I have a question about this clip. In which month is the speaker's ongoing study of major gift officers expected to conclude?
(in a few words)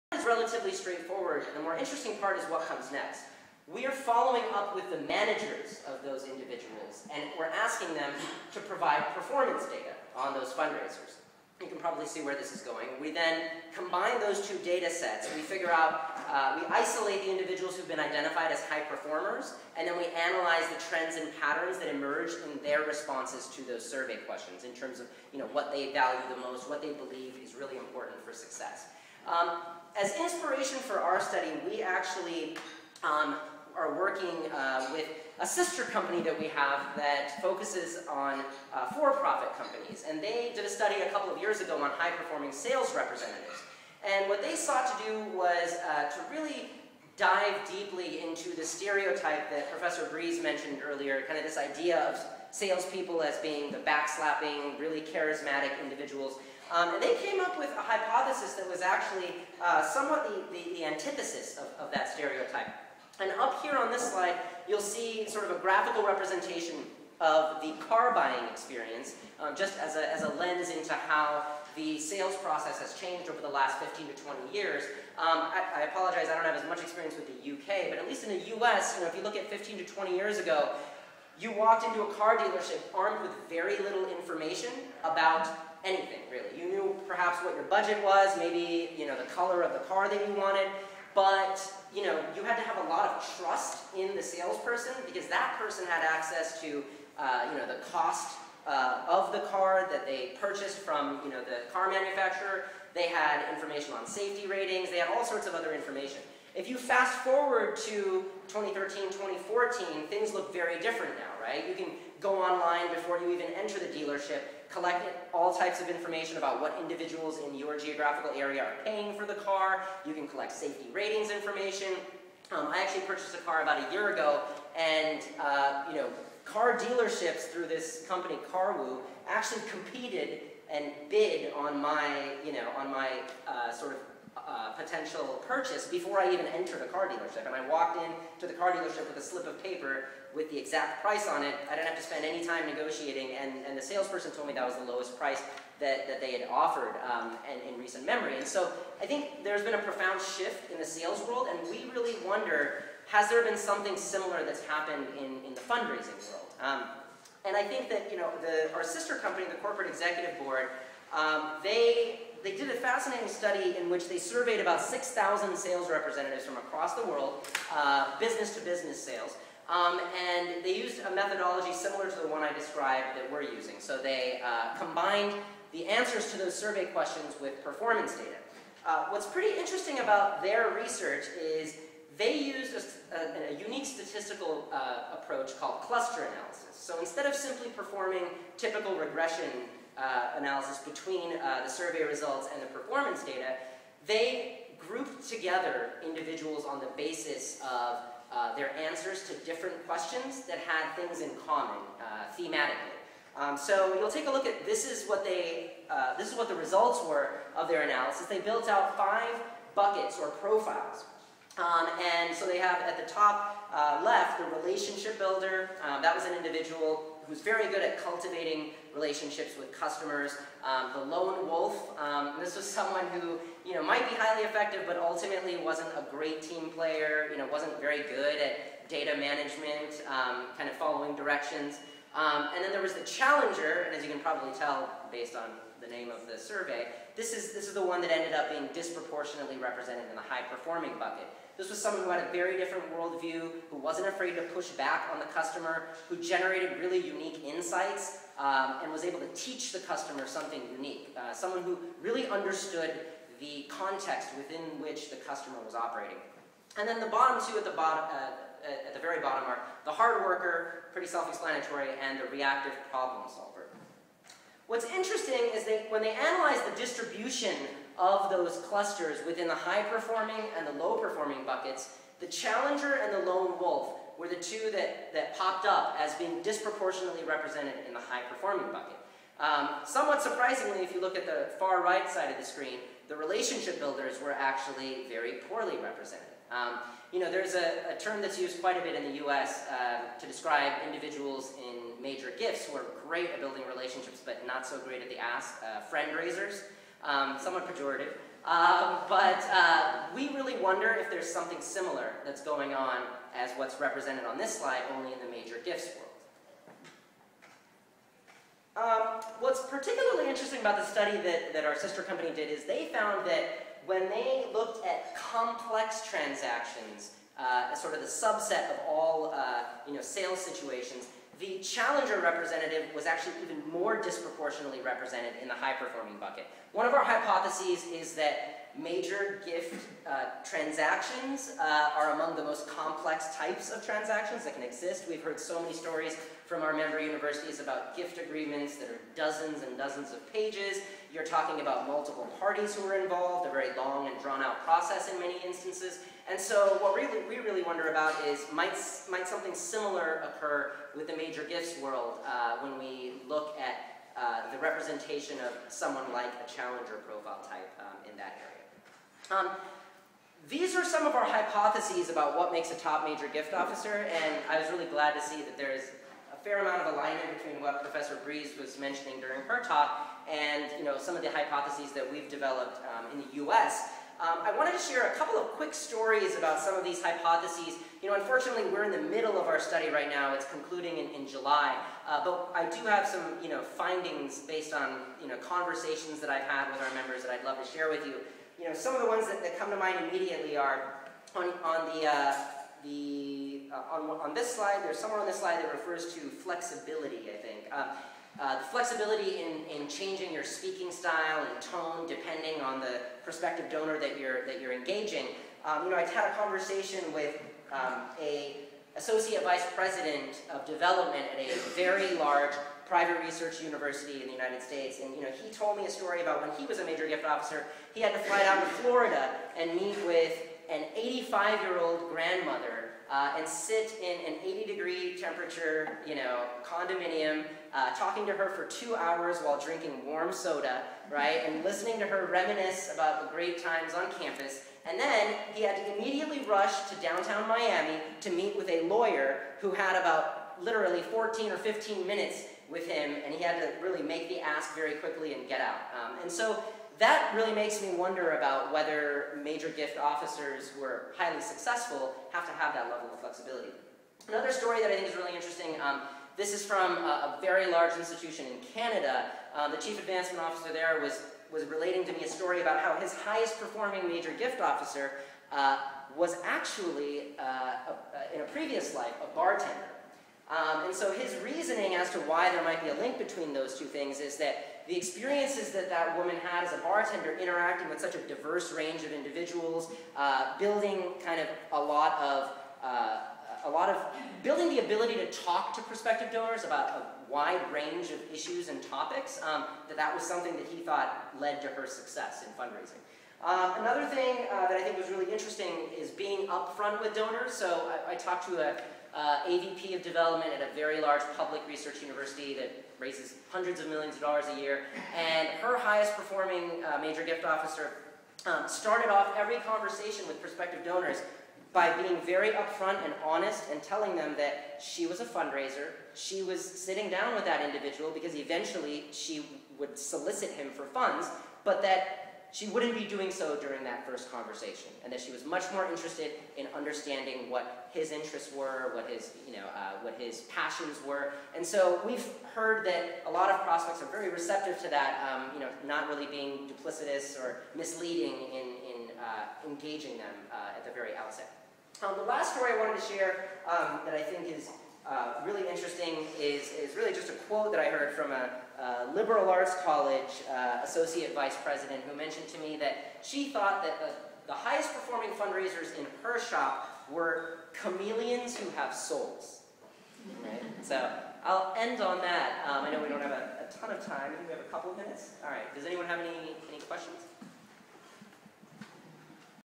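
July.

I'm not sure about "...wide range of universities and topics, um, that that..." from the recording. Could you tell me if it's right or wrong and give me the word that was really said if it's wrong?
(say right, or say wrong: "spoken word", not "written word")
wrong: "issues", not "universities".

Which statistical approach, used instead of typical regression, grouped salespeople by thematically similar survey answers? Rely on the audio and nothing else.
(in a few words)
cluster analysis.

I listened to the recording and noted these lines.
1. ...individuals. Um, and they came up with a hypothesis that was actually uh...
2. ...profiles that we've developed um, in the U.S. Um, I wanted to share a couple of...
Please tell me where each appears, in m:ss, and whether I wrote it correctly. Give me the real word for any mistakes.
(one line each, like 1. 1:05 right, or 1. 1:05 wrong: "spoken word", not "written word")
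1. 0:55 right
2. 6:11 wrong: "hypotheses", not "profiles".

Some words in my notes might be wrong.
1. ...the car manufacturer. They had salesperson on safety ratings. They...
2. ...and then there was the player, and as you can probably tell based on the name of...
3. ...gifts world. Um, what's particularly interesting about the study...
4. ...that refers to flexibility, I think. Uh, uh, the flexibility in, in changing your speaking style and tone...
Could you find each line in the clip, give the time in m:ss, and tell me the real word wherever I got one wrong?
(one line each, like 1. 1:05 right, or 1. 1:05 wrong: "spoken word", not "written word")
1. 1:41 wrong: "information", not "salesperson"
2. 3:52 wrong: "challenger", not "player"
3. 5:05 right
4. 6:35 right.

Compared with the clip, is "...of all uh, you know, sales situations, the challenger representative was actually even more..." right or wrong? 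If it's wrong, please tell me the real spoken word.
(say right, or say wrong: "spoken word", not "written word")
right.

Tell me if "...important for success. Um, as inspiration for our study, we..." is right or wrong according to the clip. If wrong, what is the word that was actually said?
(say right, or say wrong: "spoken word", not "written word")
right.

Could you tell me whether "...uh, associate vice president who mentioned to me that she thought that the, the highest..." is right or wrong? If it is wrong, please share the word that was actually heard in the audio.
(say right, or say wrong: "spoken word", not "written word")
right.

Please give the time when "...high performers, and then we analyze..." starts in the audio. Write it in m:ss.
0:18.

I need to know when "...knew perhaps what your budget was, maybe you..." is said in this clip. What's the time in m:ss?
1:26.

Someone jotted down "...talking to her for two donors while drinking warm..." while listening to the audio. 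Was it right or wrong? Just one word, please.
wrong.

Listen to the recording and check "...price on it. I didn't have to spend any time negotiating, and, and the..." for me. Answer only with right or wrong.
right.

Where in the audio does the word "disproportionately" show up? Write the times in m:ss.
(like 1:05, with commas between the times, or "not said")
3:58, 4:36, 5:24.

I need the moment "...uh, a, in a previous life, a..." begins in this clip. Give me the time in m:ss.
7:47.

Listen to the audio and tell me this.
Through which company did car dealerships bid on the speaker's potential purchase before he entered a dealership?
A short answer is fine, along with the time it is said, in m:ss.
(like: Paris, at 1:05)
CarWoo, at 2:08.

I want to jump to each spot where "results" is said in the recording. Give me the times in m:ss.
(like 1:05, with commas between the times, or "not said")
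3:12, 3:26.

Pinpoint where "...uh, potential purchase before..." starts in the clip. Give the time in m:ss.
2:14.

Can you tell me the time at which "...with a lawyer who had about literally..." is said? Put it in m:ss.
7:18.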